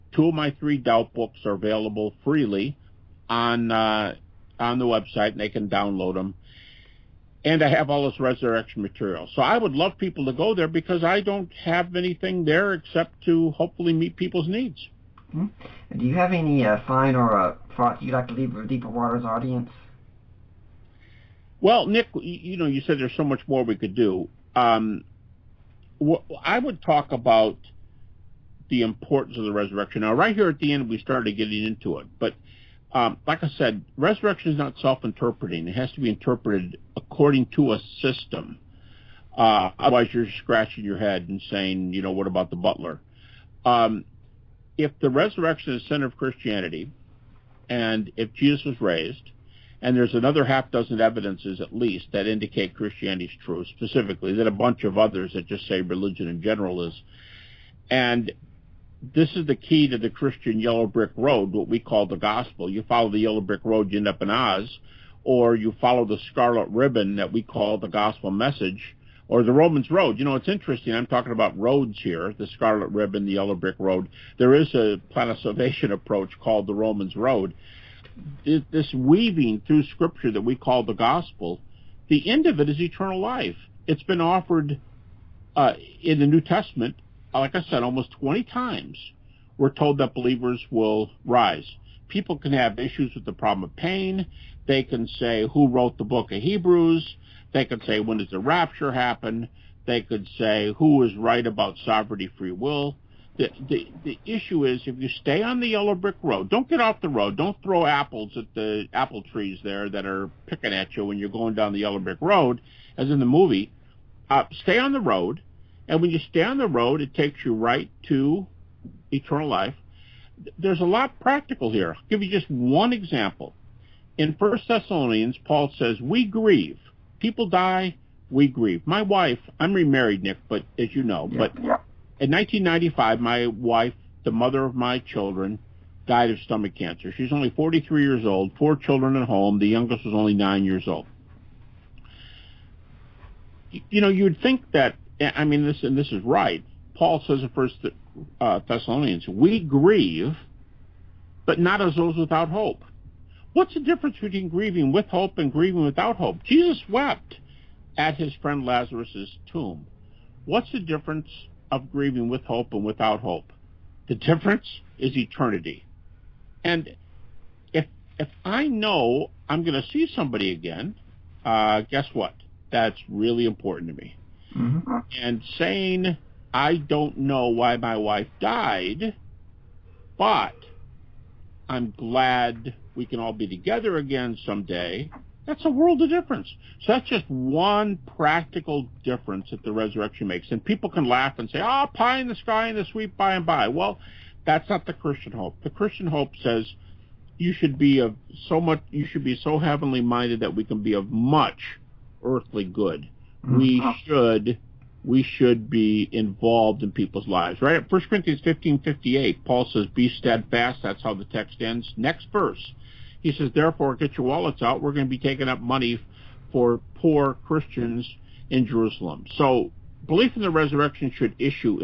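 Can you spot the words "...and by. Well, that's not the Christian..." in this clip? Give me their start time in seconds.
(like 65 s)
193 s.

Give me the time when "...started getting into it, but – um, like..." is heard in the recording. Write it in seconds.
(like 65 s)
30 s.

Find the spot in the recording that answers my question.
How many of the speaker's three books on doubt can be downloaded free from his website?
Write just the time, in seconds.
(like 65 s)
0 s.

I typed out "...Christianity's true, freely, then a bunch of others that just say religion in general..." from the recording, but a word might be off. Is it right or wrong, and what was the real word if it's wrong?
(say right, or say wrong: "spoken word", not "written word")
wrong: "specifically", not "freely".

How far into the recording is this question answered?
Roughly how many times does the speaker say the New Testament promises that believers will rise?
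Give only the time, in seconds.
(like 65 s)
87 s.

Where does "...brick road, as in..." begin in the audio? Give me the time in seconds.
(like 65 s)
111 s.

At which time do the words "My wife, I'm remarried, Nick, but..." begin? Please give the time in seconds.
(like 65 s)
128 s.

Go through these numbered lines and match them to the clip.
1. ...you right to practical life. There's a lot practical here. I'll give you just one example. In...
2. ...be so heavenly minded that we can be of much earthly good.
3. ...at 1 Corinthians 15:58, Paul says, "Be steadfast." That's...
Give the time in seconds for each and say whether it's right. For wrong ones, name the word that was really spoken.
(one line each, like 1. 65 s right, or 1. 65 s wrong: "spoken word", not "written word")
1. 117 s wrong: "eternal", not "practical"
2. 199 s right
3. 207 s right.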